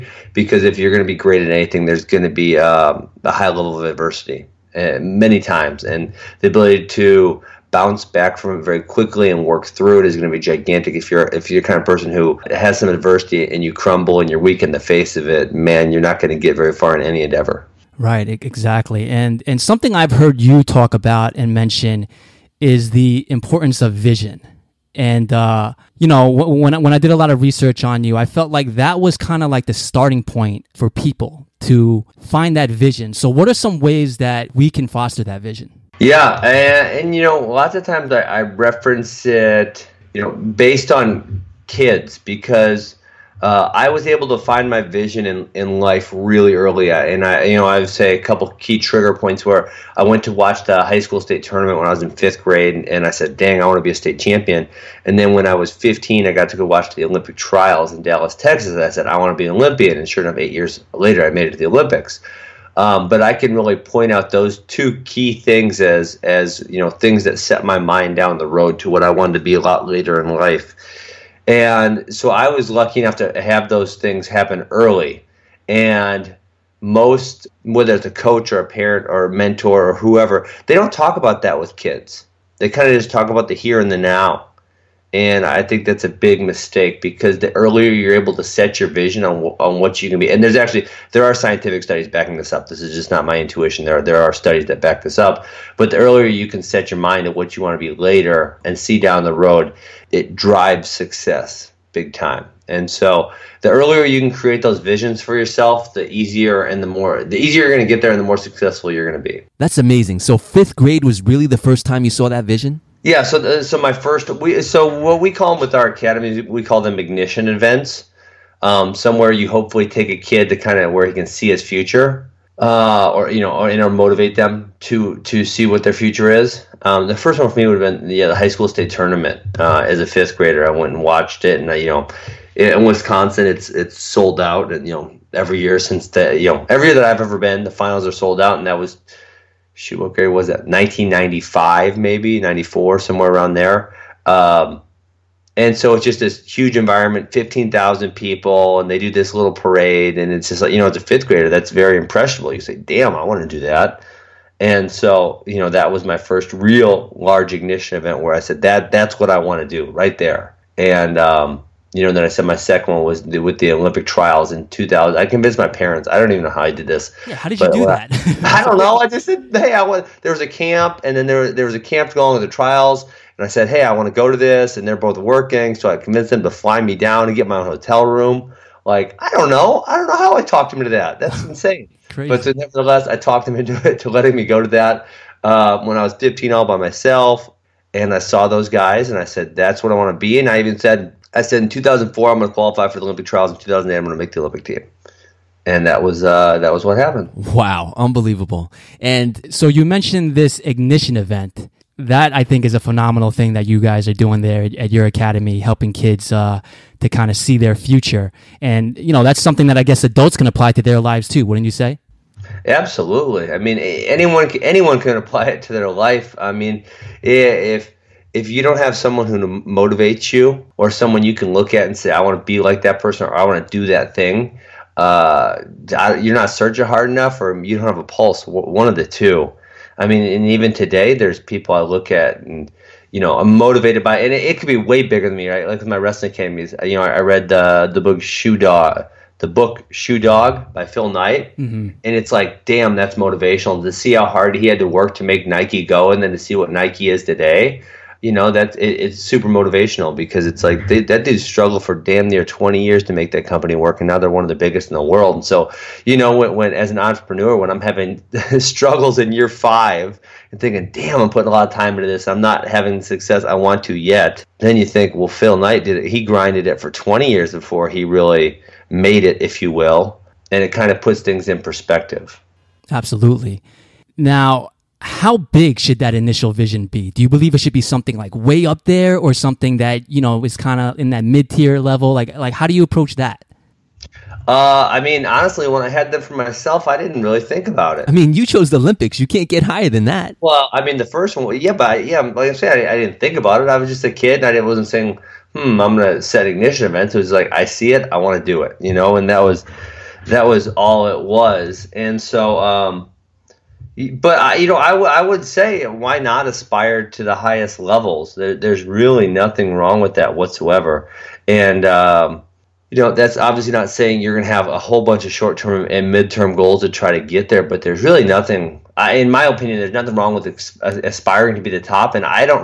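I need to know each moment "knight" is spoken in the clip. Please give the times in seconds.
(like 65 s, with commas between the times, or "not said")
241 s, 265 s.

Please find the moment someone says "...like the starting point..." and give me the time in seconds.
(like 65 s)
29 s.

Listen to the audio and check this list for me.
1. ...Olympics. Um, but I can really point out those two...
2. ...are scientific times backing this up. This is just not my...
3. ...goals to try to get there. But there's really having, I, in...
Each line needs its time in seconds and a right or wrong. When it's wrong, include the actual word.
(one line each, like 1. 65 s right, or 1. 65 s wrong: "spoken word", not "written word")
1. 61 s right
2. 91 s wrong: "studies", not "times"
3. 316 s wrong: "nothing", not "having".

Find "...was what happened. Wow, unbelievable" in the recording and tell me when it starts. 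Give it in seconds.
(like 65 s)
196 s.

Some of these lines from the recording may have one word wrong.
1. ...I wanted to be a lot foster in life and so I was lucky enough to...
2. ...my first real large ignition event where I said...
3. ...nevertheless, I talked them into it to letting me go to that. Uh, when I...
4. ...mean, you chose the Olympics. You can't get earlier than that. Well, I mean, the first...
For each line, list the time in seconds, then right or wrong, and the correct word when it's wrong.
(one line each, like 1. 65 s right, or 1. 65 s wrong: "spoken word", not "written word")
1. 69 s wrong: "later", not "foster"
2. 156 s right
3. 182 s right
4. 288 s wrong: "higher", not "earlier".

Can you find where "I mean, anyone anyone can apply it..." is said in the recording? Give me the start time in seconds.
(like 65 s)
213 s.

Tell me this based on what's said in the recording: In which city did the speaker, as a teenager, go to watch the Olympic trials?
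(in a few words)
Dallas, Texas.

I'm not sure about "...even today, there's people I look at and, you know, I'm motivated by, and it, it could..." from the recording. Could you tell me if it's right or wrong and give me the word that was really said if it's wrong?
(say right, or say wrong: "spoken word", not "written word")
right.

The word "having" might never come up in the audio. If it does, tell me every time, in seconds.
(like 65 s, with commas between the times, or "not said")
257 s, 262 s.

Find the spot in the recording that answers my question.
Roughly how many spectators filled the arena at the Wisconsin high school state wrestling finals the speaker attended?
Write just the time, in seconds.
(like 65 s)
147 s.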